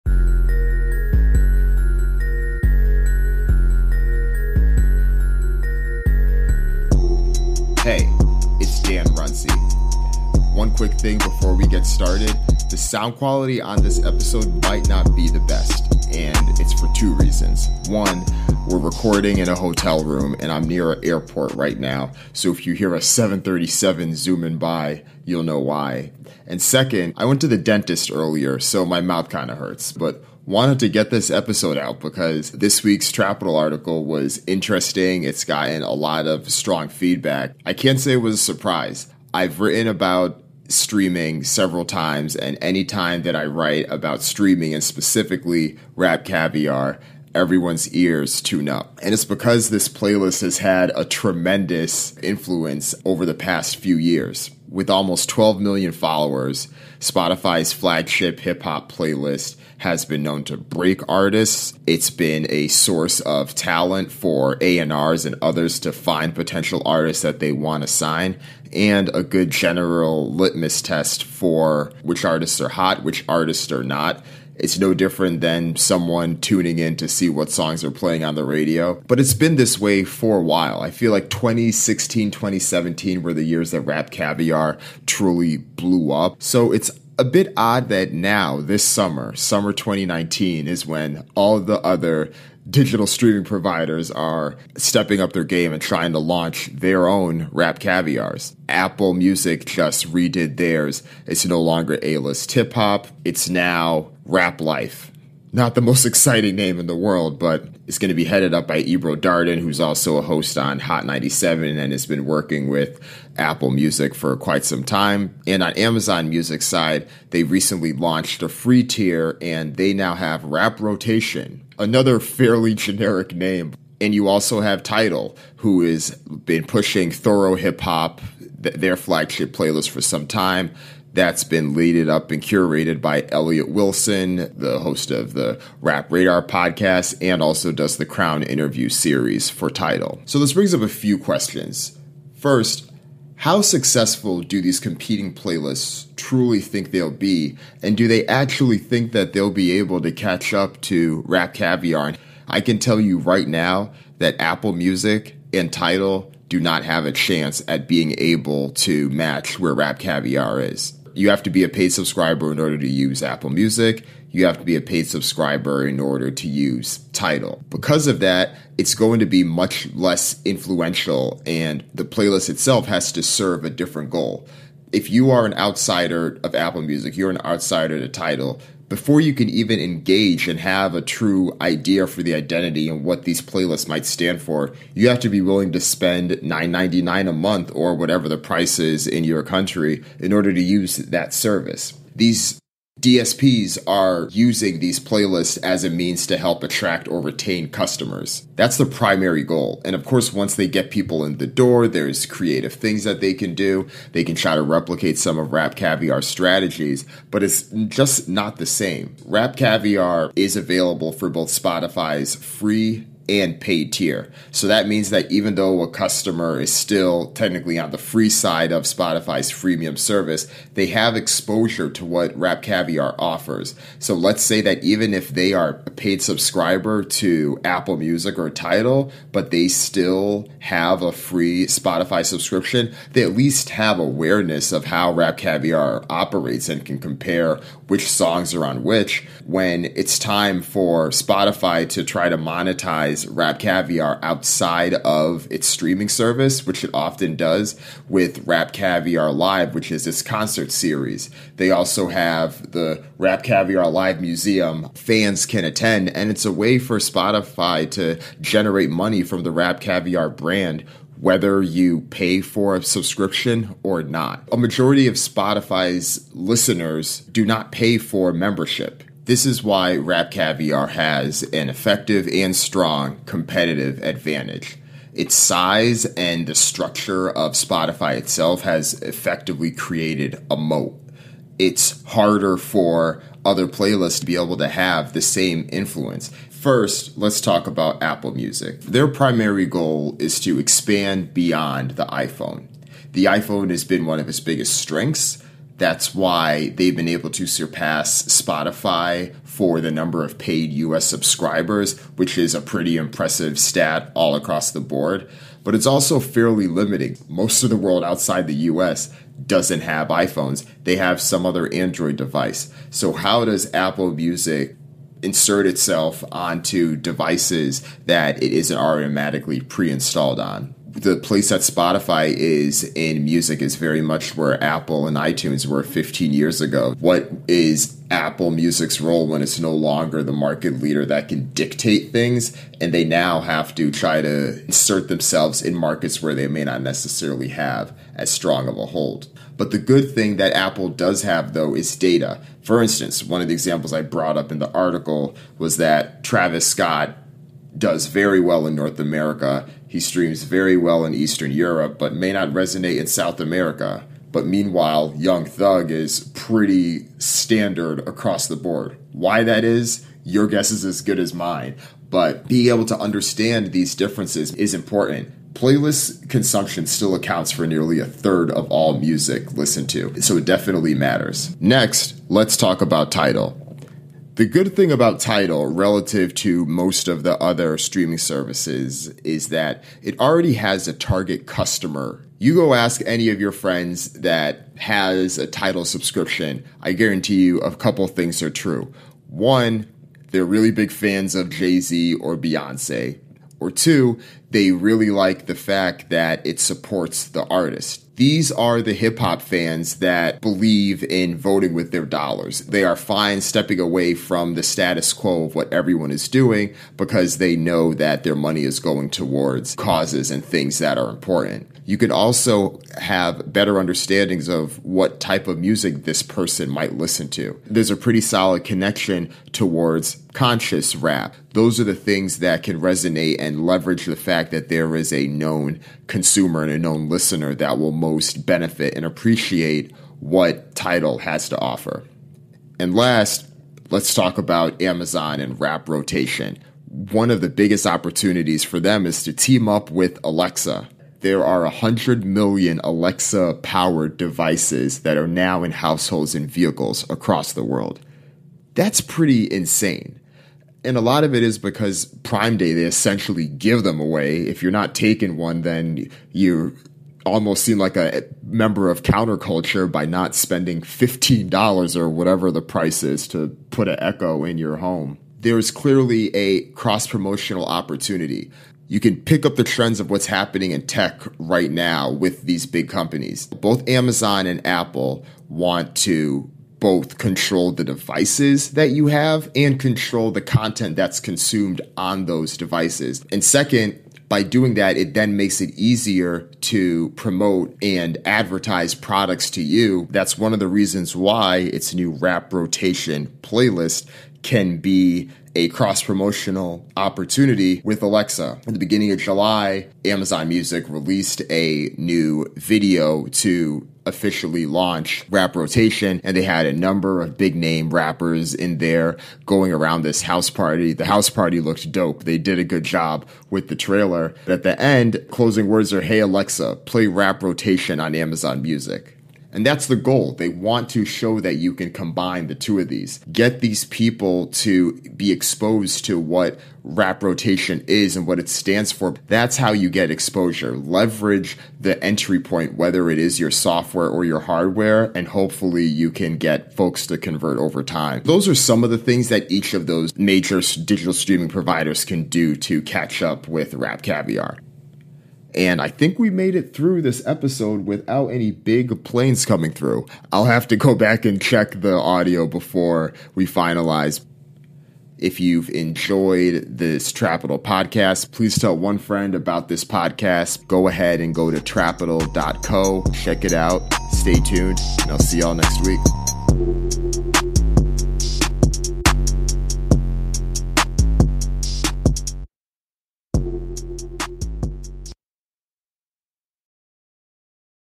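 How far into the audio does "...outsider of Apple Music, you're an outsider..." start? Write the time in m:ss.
2:55.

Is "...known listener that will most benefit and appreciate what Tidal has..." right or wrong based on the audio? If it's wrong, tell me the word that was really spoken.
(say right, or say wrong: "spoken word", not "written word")
right.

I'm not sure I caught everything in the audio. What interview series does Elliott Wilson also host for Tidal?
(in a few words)
Crown.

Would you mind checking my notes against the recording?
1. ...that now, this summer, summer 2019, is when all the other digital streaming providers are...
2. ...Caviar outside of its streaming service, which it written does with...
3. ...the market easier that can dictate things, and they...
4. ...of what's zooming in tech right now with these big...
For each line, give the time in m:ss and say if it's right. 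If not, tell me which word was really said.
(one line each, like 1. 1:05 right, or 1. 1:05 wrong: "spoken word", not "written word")
1. 1:27 right
2. 4:03 wrong: "often", not "written"
3. 5:30 wrong: "leader", not "easier"
4. 7:49 wrong: "happening", not "zooming".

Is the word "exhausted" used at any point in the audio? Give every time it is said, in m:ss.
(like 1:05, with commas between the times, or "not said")
not said.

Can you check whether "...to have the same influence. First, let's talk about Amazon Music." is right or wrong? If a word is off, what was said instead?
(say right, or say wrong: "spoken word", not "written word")
wrong: "Apple", not "Amazon".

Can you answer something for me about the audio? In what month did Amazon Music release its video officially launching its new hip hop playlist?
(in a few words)
July.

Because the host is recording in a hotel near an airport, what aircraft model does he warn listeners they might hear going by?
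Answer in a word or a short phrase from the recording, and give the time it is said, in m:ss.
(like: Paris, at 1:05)
737, at 0:23.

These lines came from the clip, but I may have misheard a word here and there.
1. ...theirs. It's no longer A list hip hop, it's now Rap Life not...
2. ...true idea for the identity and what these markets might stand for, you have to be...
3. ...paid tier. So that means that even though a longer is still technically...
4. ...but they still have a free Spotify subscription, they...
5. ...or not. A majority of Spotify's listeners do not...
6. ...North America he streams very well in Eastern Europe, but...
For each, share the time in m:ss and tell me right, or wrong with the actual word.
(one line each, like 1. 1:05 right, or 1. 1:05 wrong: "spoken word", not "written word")
1. 1:40 right
2. 3:01 wrong: "playlists", not "markets"
3. 3:33 wrong: "customer", not "longer"
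4. 3:49 right
5. 4:23 right
6. 5:48 right.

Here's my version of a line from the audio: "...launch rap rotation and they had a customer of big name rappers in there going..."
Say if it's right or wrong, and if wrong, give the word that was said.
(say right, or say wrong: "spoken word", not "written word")
wrong: "number", not "customer".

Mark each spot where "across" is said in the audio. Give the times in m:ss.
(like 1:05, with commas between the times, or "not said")
5:04, 5:58, 7:27.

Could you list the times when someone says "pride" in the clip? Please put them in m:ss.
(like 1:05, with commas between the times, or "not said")
not said.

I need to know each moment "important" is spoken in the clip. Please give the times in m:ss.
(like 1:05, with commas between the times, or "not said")
6:04, 6:51.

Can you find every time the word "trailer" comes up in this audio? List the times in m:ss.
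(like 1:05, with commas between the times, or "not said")
8:33.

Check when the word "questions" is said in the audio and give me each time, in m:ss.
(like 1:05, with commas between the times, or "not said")
2:21.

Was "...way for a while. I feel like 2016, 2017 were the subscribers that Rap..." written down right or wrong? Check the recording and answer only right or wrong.
wrong.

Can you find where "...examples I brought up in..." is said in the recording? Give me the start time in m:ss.
5:43.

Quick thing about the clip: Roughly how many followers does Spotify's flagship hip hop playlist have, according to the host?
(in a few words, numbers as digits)
12 million.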